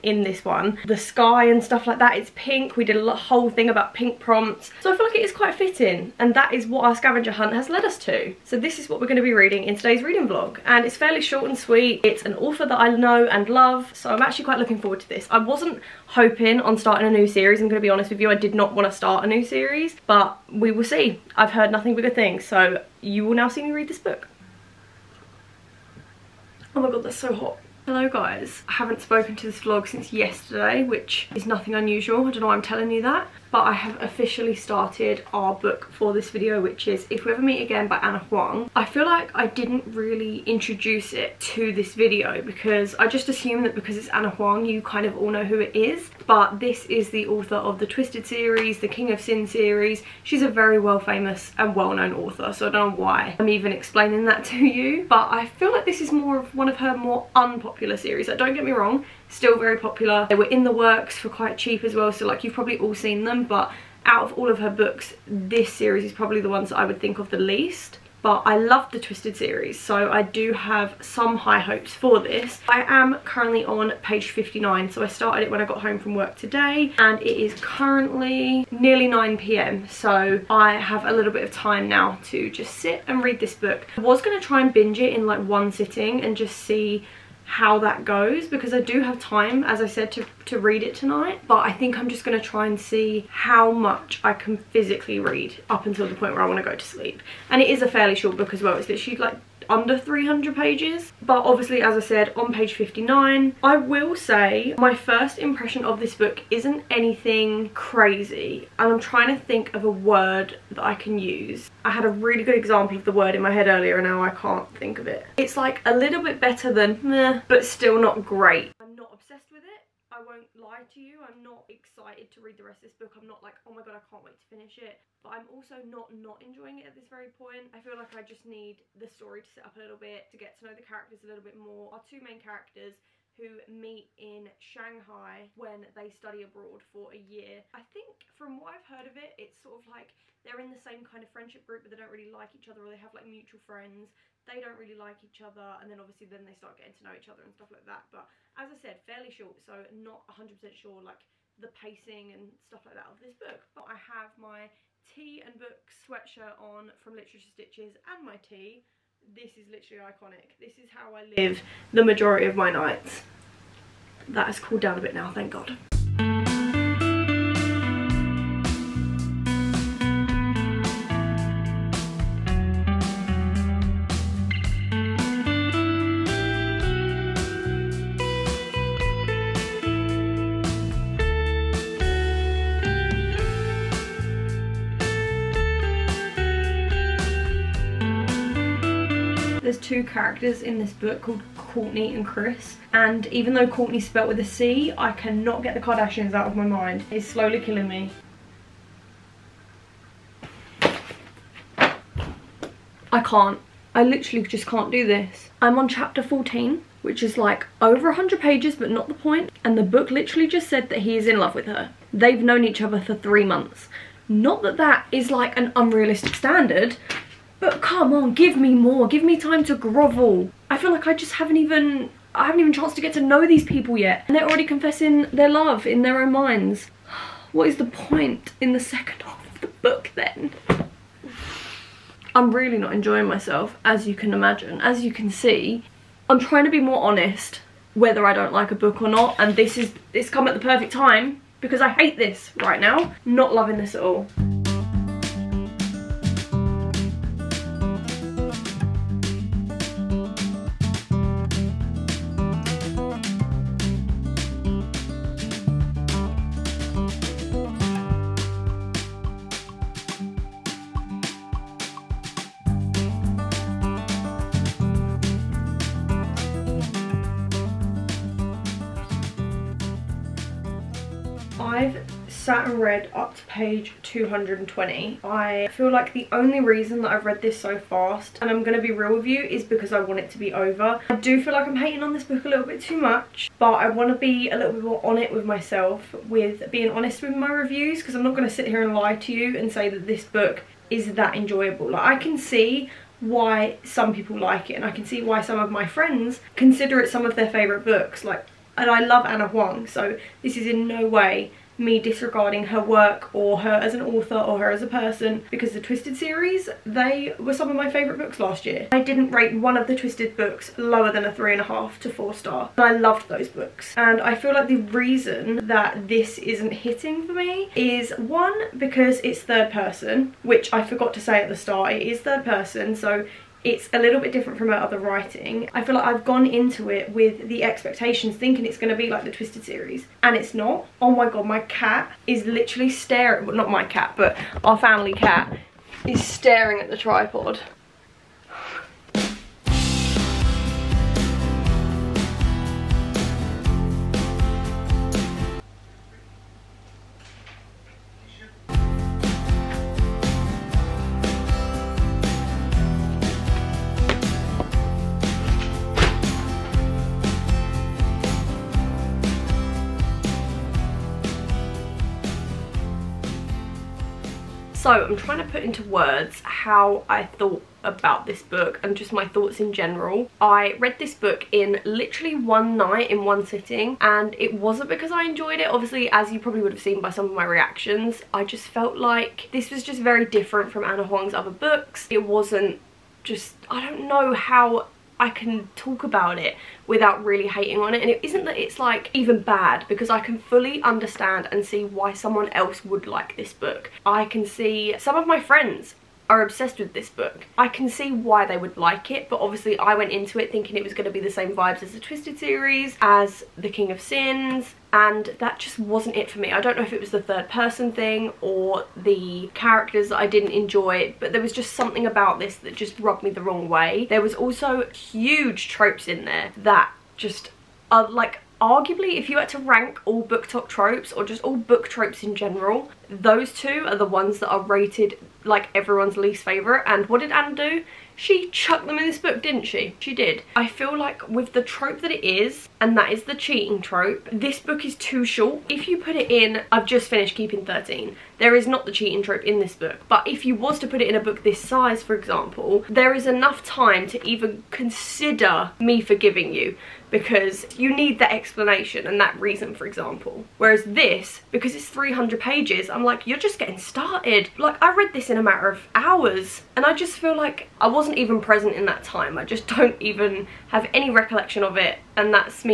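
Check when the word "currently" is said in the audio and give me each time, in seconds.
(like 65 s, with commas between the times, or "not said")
73 s, 77 s.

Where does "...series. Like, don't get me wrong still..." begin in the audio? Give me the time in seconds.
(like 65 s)
57 s.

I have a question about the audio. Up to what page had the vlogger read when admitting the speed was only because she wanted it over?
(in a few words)
220.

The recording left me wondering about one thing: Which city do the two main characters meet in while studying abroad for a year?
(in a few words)
Shanghai.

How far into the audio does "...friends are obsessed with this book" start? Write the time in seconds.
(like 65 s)
395 s.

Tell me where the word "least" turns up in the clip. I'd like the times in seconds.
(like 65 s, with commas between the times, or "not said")
67 s, 426 s.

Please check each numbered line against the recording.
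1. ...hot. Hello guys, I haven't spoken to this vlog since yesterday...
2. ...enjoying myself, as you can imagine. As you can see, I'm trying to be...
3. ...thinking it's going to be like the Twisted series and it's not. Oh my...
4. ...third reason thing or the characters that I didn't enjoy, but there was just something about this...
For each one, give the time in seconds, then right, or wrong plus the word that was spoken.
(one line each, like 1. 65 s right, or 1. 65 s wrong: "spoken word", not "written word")
1. 27 s right
2. 232 s right
3. 328 s right
4. 407 s wrong: "person", not "reason".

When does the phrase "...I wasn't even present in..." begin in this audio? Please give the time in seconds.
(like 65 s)
457 s.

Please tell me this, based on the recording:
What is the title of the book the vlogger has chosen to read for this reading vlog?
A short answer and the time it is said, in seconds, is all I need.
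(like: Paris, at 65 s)
If We Ever Meet Again, at 37 s.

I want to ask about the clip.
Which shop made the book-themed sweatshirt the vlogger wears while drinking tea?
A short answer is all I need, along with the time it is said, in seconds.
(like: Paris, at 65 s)
Literature Stitches, at 157 s.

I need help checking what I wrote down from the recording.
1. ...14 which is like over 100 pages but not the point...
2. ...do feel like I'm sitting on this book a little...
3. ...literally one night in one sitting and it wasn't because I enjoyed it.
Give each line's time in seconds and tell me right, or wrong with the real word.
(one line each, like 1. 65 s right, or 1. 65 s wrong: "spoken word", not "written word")
1. 206 s right
2. 281 s wrong: "hating", not "sitting"
3. 371 s right.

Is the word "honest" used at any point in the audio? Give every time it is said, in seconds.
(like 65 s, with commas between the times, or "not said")
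17 s, 237 s, 286 s.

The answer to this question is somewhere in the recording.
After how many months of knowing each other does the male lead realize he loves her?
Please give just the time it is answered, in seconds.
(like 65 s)
213 s.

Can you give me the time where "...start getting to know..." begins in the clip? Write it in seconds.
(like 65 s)
146 s.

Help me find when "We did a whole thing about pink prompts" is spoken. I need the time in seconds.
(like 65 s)
2 s.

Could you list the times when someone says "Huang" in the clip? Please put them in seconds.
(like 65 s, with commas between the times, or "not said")
38 s, 44 s, 299 s, 381 s.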